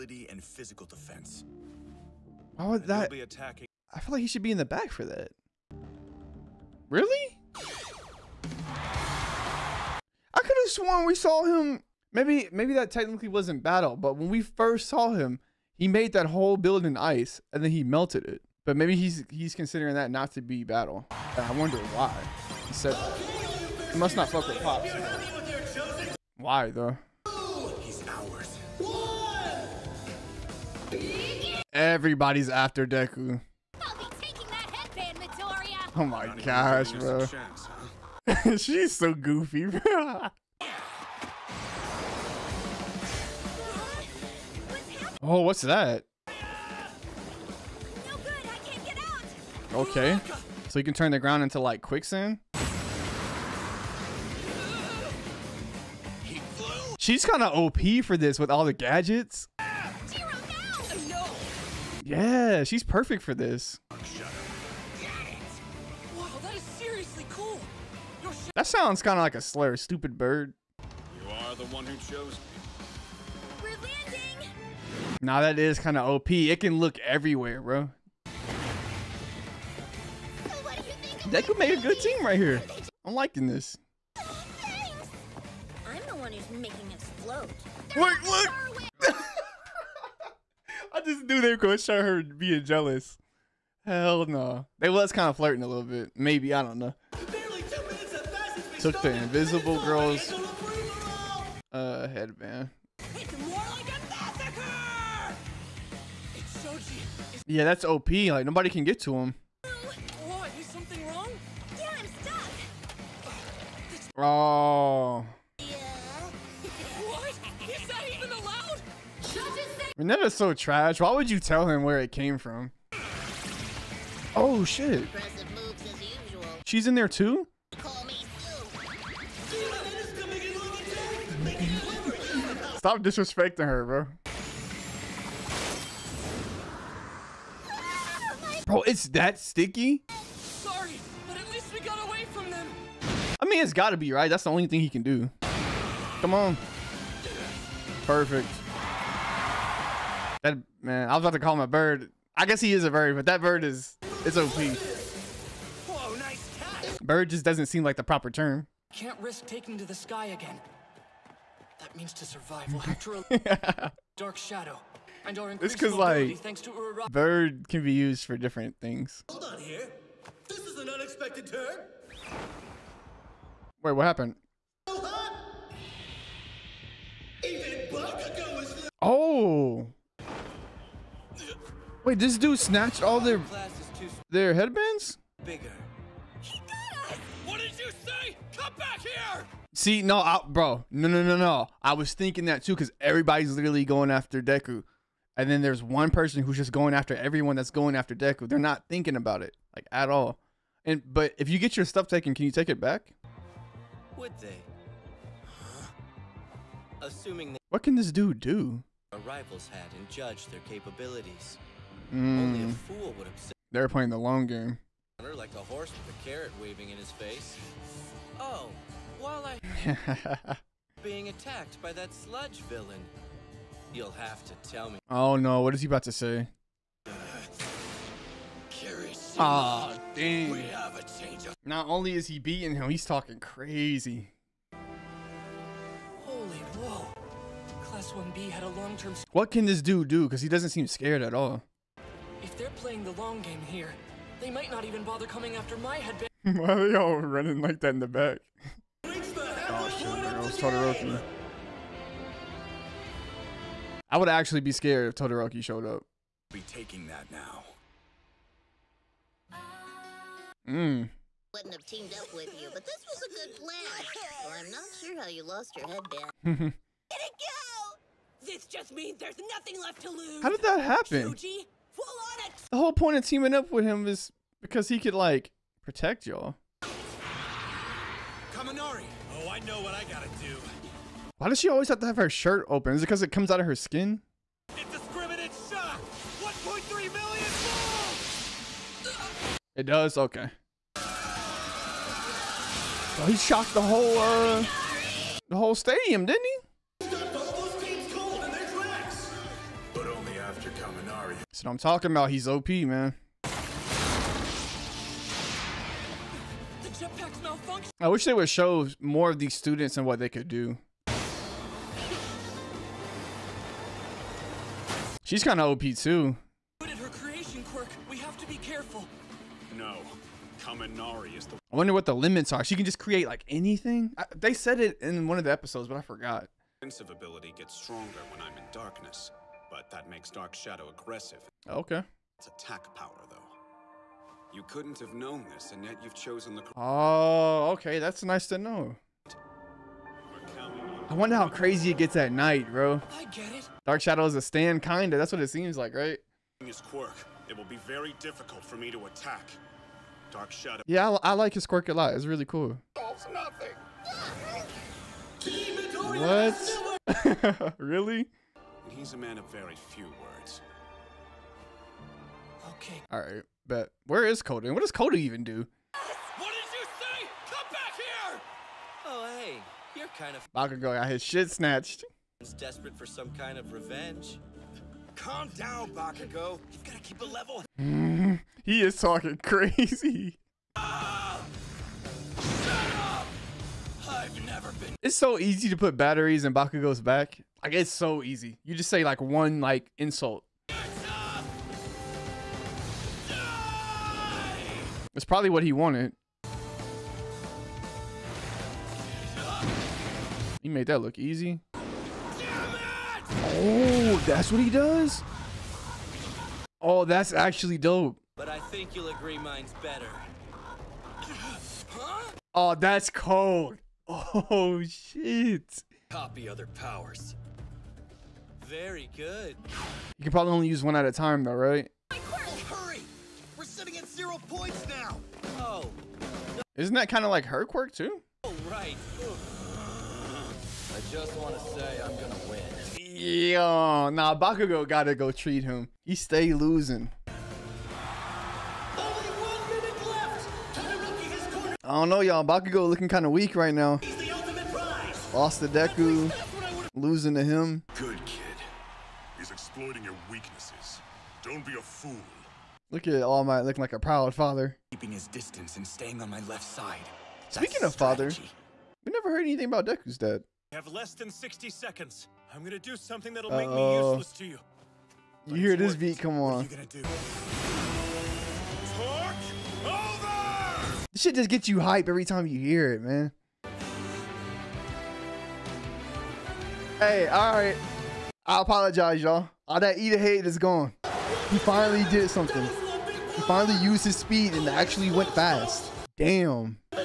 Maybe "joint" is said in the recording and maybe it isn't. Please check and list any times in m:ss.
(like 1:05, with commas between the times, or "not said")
not said.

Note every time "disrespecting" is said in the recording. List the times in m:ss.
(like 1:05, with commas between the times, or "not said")
2:13.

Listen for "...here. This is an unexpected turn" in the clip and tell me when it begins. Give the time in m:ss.
2:49.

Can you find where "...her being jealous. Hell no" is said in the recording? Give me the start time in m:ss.
1:32.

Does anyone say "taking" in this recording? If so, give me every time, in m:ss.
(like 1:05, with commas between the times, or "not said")
2:39, 4:16.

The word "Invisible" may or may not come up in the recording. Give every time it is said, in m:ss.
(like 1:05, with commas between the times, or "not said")
1:39.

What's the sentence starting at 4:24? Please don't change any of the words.
Well, I'm not sure how you lost your headband.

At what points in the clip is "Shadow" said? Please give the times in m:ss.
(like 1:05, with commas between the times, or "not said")
2:44, 5:30, 5:44, 5:50.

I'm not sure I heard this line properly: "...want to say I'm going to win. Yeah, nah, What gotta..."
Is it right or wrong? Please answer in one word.
wrong.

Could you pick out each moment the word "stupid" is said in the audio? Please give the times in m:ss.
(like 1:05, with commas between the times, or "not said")
1:09.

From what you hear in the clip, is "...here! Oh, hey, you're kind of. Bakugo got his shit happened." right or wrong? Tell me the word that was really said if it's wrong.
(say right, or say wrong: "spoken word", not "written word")
wrong: "snatched", not "happened".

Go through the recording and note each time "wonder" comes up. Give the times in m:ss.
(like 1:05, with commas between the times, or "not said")
0:21, 5:21, 5:41.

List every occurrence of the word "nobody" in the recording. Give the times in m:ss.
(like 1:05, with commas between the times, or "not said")
1:48.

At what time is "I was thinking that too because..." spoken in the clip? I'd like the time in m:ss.
3:11.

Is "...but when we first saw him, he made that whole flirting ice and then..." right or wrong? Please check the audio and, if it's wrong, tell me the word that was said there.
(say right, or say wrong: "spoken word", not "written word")
wrong: "building", not "flirting".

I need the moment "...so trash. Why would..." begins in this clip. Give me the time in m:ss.
2:00.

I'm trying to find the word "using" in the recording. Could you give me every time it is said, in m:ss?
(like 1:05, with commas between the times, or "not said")
not said.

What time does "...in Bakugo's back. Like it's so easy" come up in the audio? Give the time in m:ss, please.
6:26.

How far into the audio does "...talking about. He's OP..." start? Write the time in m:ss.
5:01.